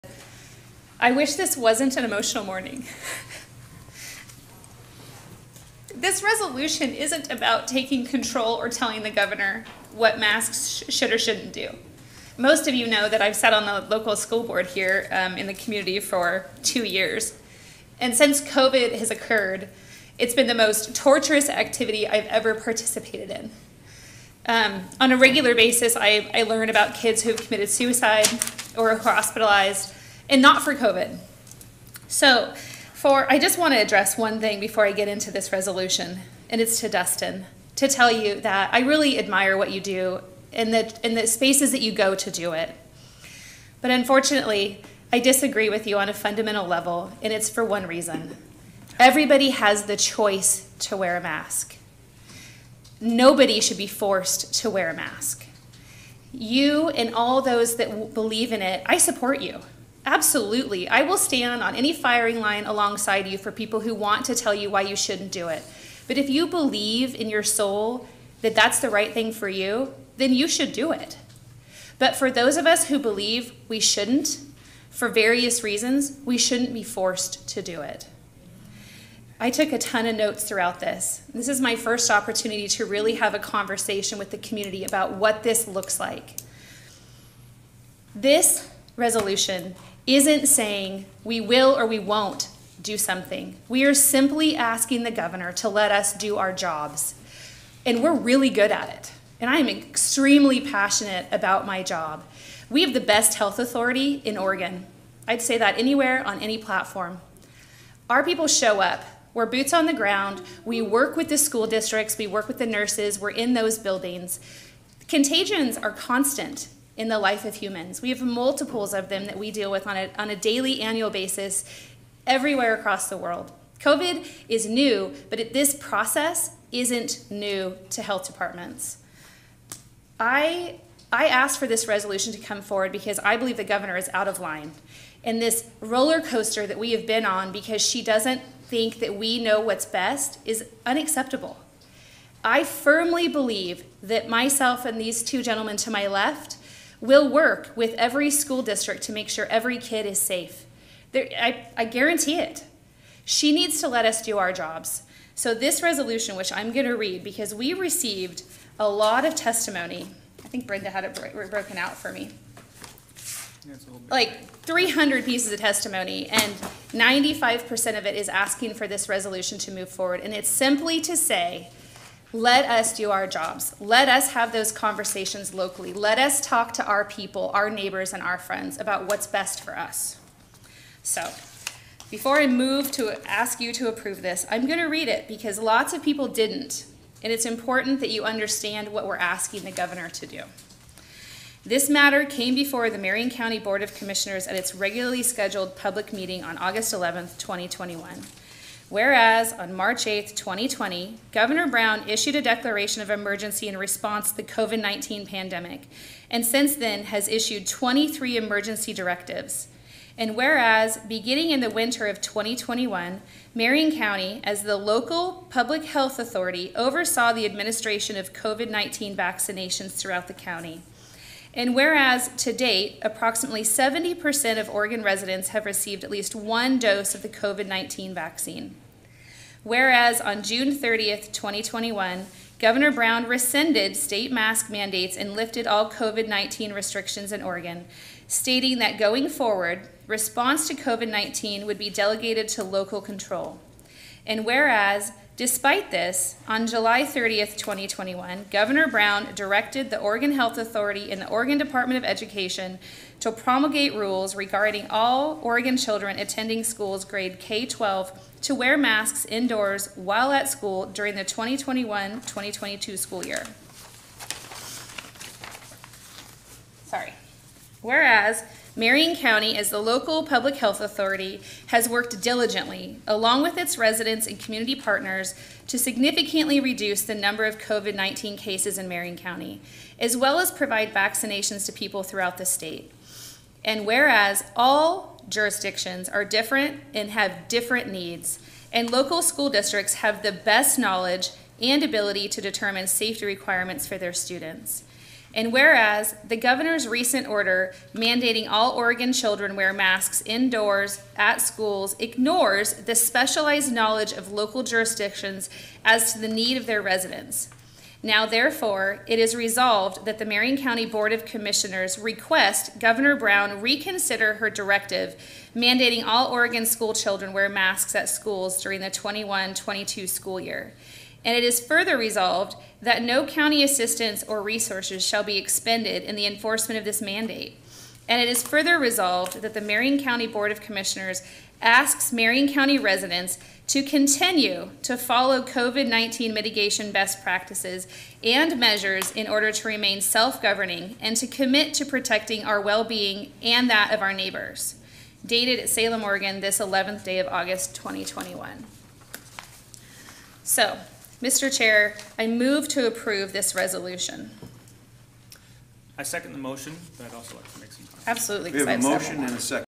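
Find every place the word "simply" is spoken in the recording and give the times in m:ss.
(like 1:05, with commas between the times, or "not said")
1:33, 2:50.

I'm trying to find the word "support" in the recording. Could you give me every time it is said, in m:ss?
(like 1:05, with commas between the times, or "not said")
0:58.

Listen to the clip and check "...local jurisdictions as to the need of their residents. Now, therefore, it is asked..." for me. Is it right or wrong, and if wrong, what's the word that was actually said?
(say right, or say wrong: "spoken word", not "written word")
wrong: "resolved", not "asked".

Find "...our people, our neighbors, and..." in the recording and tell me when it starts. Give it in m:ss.
2:56.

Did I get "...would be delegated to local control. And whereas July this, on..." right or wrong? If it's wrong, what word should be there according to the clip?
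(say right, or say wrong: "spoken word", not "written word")
wrong: "Despite", not "July".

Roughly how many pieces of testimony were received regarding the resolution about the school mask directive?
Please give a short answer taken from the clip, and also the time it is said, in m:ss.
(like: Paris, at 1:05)
300, at 2:44.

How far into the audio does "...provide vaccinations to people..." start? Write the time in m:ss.
4:40.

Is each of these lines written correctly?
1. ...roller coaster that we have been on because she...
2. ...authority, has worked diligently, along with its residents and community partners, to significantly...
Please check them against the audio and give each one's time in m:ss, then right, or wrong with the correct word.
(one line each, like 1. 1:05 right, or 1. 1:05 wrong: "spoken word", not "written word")
1. 2:15 right
2. 4:30 right.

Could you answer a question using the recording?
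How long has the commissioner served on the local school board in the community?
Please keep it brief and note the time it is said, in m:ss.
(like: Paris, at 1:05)
2 years, at 0:16.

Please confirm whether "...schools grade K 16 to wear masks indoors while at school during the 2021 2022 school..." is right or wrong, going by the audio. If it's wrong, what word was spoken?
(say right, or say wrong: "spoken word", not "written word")
wrong: "12", not "16".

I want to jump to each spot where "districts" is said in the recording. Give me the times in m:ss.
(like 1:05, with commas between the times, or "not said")
1:51, 2:28, 4:49.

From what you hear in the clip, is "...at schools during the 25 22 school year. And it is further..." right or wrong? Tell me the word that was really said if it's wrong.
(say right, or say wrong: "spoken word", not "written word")
wrong: "21", not "25".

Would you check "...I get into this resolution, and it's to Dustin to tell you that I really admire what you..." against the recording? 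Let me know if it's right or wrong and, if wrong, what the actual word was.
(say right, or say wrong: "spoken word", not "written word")
right.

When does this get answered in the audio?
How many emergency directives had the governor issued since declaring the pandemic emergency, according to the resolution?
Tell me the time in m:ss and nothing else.
3:27.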